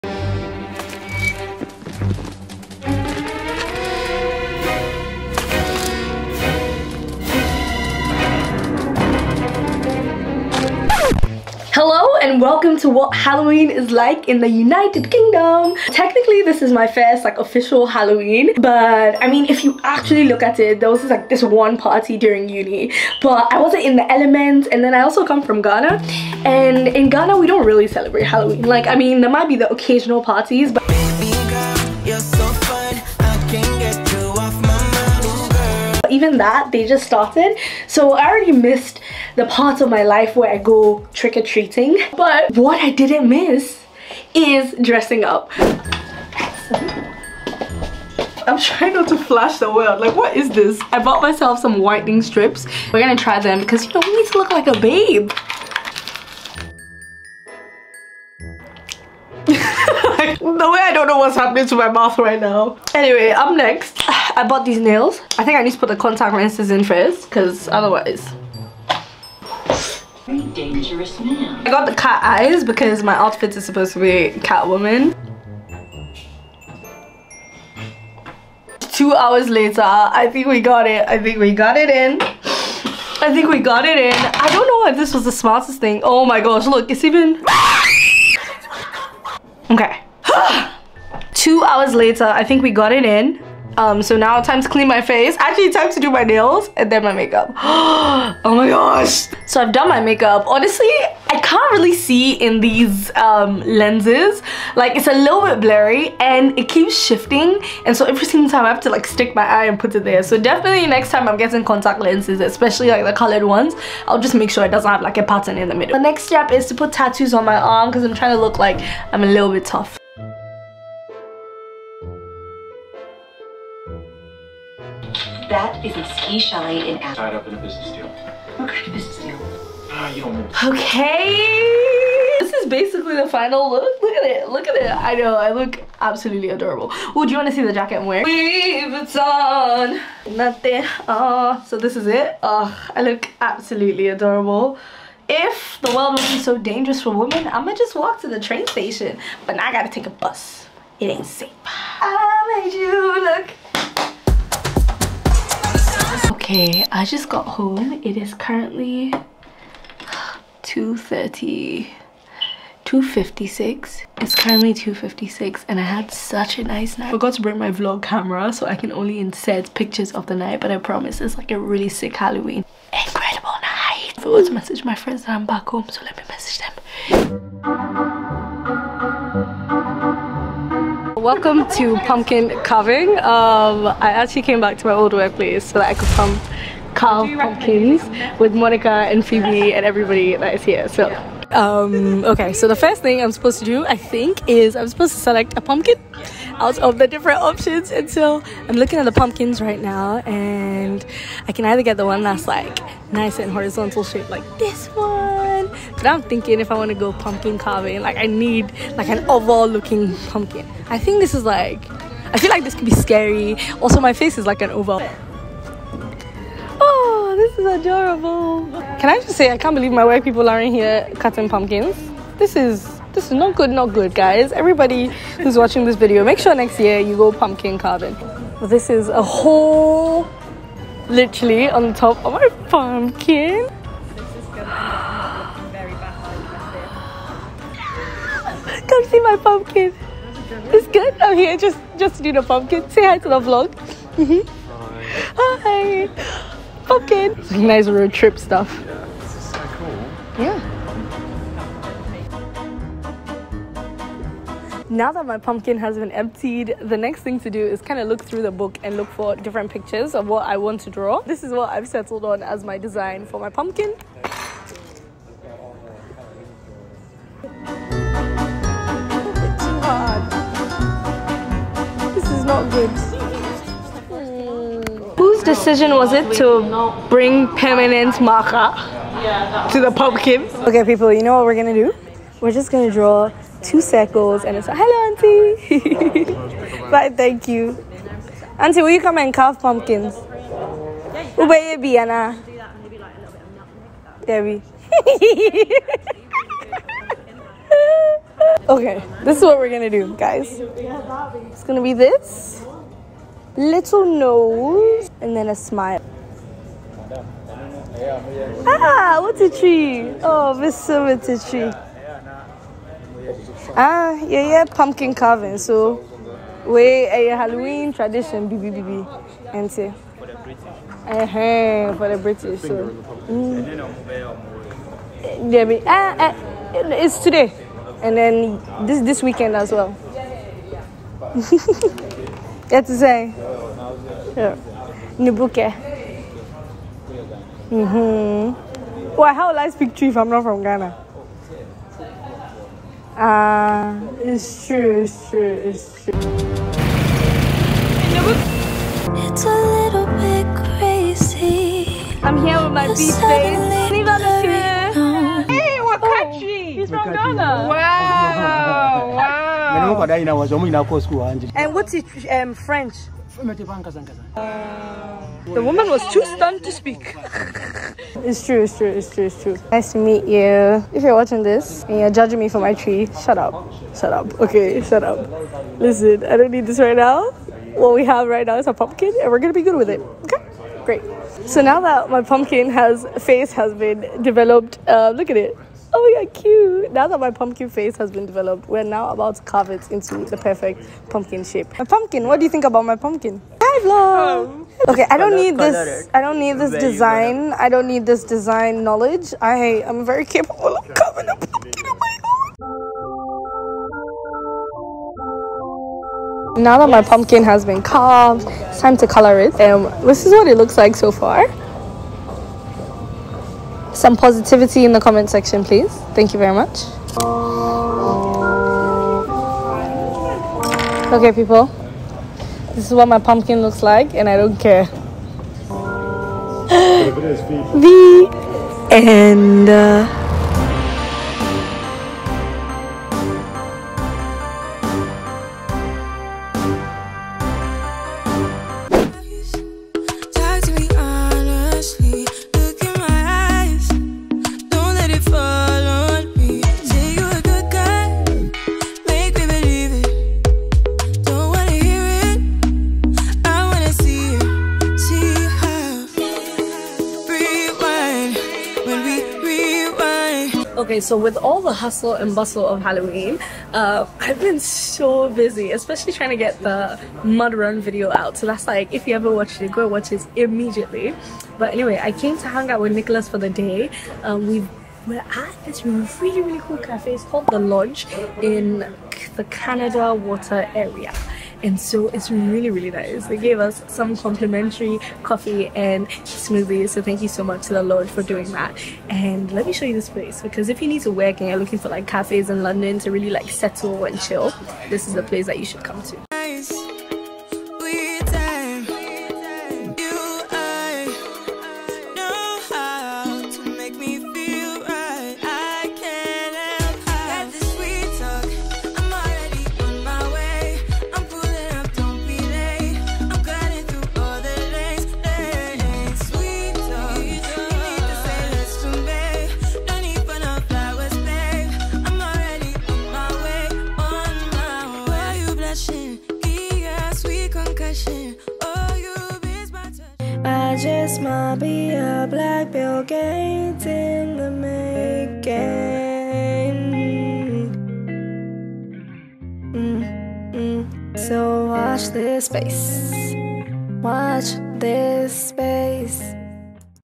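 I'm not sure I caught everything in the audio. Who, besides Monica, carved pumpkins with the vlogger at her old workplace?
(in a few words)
Phoebe.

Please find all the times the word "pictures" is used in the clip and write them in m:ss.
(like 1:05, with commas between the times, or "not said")
2:49, 4:19.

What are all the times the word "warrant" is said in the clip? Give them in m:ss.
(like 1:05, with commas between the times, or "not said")
not said.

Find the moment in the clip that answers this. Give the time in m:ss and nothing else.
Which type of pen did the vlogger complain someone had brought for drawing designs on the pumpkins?
4:37.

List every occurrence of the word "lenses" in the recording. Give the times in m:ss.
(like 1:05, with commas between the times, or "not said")
1:06, 1:43, 1:51.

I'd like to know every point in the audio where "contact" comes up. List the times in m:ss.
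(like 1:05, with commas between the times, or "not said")
1:05, 1:51.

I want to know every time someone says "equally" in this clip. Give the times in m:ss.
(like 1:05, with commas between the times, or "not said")
not said.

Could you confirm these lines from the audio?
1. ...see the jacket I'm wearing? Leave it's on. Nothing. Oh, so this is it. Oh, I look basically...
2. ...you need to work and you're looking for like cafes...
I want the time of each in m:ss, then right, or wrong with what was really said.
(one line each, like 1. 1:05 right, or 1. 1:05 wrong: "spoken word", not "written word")
1. 2:17 wrong: "absolutely", not "basically"
2. 8:10 right.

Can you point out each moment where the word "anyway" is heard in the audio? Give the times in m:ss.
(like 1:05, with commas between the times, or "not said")
1:02, 7:51.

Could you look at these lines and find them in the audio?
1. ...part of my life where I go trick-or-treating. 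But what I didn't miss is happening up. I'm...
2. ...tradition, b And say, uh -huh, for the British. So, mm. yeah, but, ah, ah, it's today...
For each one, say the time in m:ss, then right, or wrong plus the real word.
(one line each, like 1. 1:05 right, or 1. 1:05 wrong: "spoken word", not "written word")
1. 0:39 wrong: "dressing", not "happening"
2. 5:17 right.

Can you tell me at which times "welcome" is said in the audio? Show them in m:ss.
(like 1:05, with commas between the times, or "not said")
0:12, 3:01.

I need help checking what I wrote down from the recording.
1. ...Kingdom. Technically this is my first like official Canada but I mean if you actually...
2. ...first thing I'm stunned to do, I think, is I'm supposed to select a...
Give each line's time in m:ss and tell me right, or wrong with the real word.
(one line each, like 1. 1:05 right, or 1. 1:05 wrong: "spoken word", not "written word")
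1. 0:15 wrong: "Halloween", not "Canada"
2. 3:12 wrong: "supposed", not "stunned".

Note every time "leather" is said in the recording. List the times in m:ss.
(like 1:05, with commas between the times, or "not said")
not said.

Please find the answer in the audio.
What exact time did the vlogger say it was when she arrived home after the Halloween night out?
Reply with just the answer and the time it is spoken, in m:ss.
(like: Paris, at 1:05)
2:56, at 2:44.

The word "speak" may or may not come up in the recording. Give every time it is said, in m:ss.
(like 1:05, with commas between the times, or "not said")
5:39, 6:06.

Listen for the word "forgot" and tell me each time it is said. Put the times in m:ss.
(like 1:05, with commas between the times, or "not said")
2:47, 2:54.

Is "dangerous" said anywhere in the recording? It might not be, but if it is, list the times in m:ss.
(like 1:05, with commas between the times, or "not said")
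1:10, 2:26.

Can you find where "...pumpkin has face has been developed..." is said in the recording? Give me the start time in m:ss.
6:22.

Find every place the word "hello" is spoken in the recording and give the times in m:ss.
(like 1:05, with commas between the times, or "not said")
4:44.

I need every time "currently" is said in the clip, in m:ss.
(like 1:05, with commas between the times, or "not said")
2:38, 2:44.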